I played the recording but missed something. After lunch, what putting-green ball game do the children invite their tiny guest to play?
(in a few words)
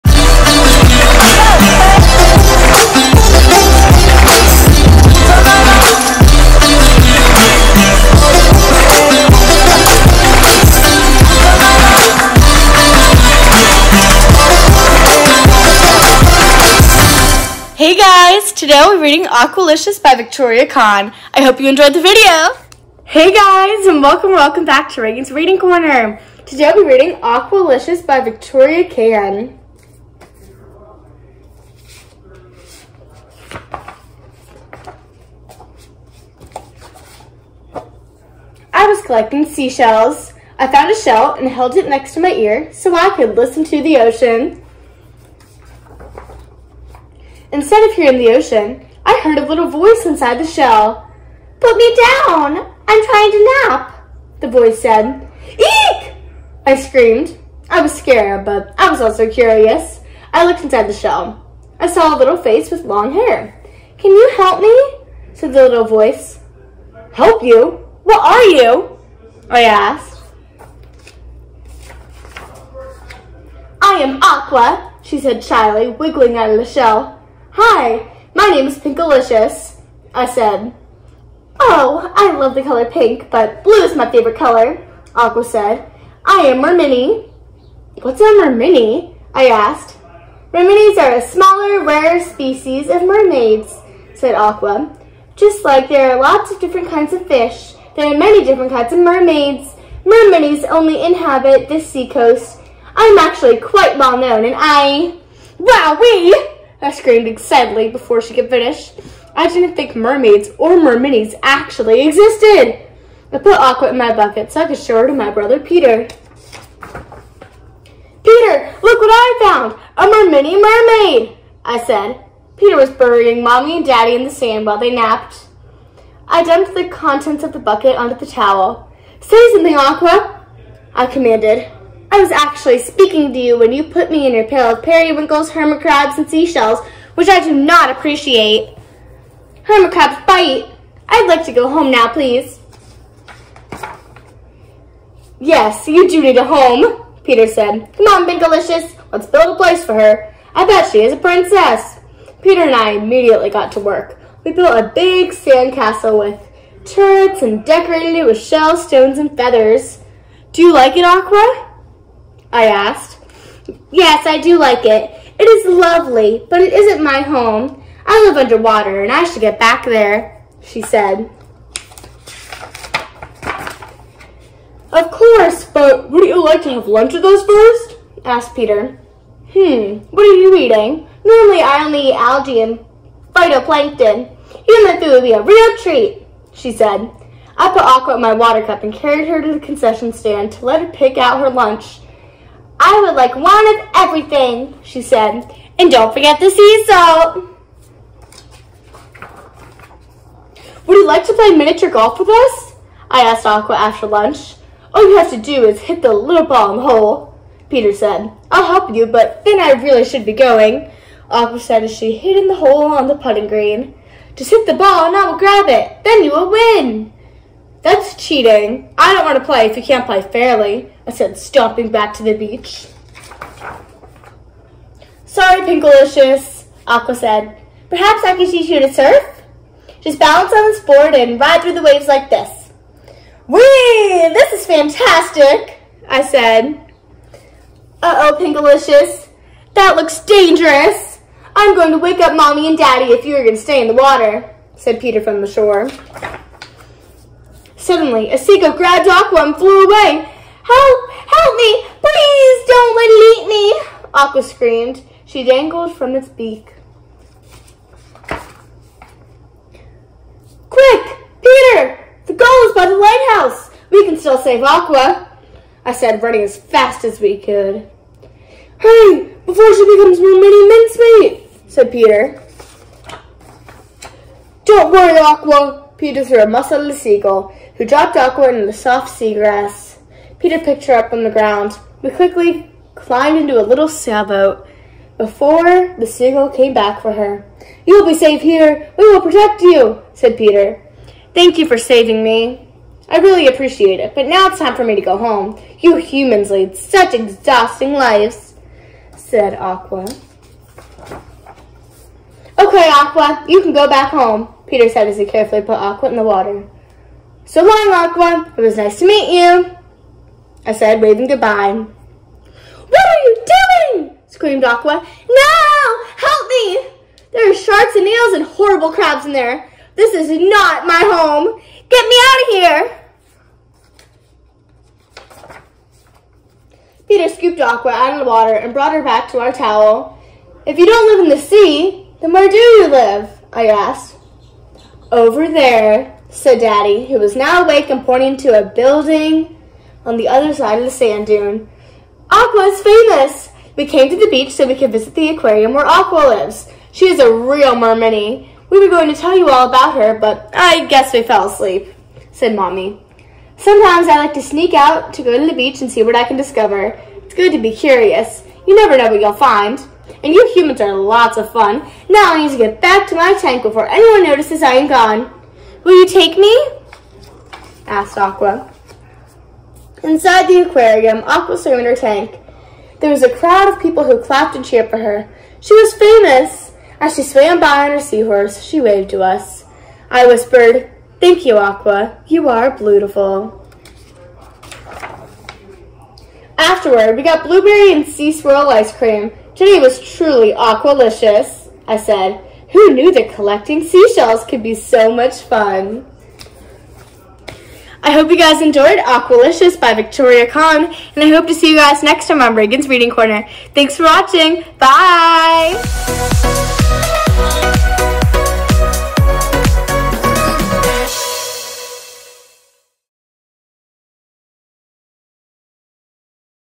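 miniature golf.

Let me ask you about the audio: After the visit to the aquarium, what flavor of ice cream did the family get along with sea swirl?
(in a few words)
blueberry.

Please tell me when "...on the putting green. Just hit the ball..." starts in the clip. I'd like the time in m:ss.
3:32.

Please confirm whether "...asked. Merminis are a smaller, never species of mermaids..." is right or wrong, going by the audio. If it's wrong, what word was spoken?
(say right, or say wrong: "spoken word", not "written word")
wrong: "rarer", not "never".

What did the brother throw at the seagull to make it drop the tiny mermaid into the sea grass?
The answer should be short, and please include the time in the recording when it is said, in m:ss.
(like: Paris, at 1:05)
a mussel, at 4:36.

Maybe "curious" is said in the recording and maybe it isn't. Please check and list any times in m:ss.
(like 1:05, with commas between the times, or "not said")
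0:59, 5:57.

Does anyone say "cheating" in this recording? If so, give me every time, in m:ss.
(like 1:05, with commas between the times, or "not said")
3:38.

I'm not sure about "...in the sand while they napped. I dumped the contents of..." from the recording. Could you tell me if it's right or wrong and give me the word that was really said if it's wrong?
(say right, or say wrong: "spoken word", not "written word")
right.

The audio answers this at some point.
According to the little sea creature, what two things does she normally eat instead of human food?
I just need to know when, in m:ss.
3:02.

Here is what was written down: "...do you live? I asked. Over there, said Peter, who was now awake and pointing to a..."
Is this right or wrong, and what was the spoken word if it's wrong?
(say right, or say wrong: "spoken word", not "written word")
wrong: "Daddy", not "Peter".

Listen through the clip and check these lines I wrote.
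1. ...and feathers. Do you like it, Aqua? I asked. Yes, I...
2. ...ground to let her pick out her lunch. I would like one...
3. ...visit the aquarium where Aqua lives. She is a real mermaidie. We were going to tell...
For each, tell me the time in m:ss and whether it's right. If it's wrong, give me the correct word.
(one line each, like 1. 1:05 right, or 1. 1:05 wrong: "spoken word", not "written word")
1. 2:39 right
2. 3:10 wrong: "stand", not "ground"
3. 5:44 right.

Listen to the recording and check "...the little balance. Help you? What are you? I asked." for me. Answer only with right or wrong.
wrong.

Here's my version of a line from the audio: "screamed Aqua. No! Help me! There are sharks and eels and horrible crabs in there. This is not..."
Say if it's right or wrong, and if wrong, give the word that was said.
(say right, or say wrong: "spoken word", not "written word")
right.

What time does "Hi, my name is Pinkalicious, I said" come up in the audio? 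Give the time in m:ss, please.
1:17.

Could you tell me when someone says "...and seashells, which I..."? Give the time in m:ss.
2:16.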